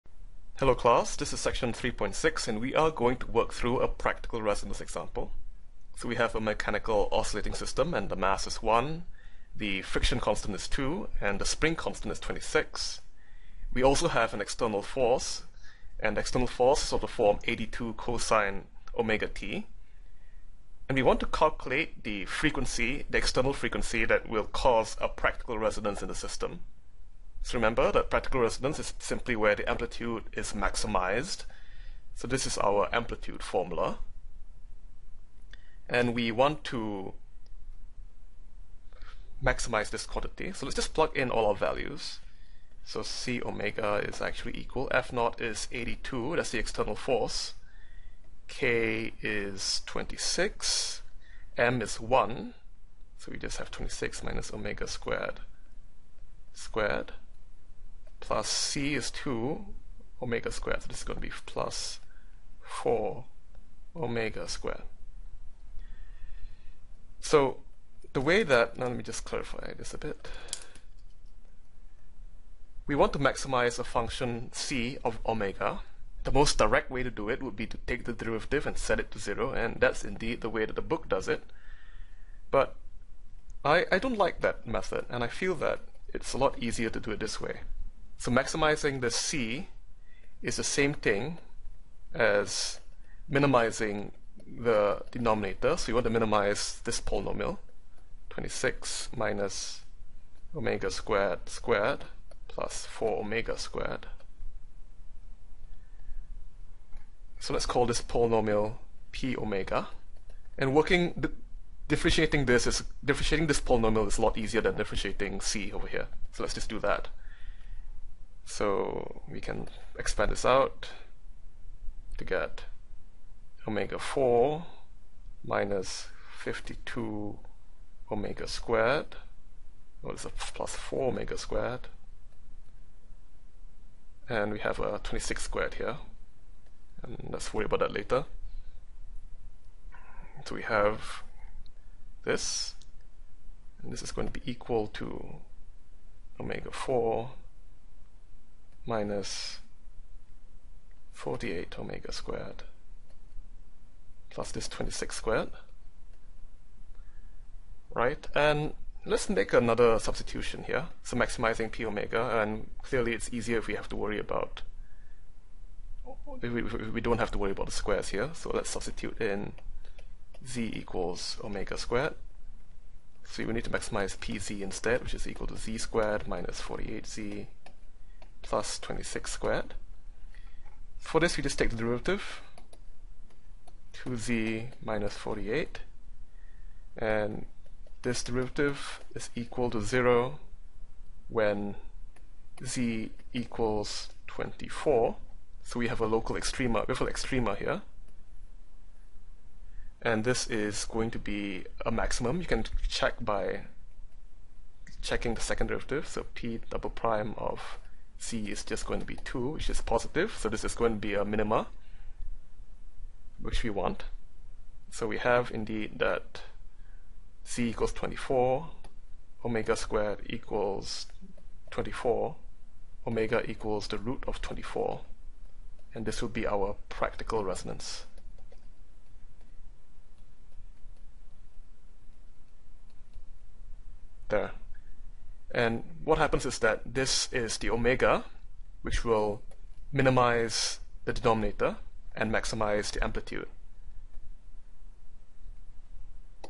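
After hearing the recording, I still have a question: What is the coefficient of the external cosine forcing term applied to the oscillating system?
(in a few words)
82.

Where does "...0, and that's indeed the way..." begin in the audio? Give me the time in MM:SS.
01:19.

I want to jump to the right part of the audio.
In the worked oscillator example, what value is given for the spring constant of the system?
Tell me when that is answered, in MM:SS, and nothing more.
00:11.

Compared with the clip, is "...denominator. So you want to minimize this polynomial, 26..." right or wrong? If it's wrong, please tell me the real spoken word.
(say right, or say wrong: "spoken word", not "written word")
right.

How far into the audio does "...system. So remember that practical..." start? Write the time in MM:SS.
00:26.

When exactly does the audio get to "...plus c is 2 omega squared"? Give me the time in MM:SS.
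00:58.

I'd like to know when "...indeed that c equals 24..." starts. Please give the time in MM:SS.
03:35.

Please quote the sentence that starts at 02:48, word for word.
So let's substitute in z equals omega squared.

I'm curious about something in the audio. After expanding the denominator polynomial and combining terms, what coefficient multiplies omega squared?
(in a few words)
-48.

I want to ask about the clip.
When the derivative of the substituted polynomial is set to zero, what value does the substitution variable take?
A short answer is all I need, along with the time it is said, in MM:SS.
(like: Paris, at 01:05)
24, at 03:12.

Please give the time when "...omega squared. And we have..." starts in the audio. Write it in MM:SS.
02:11.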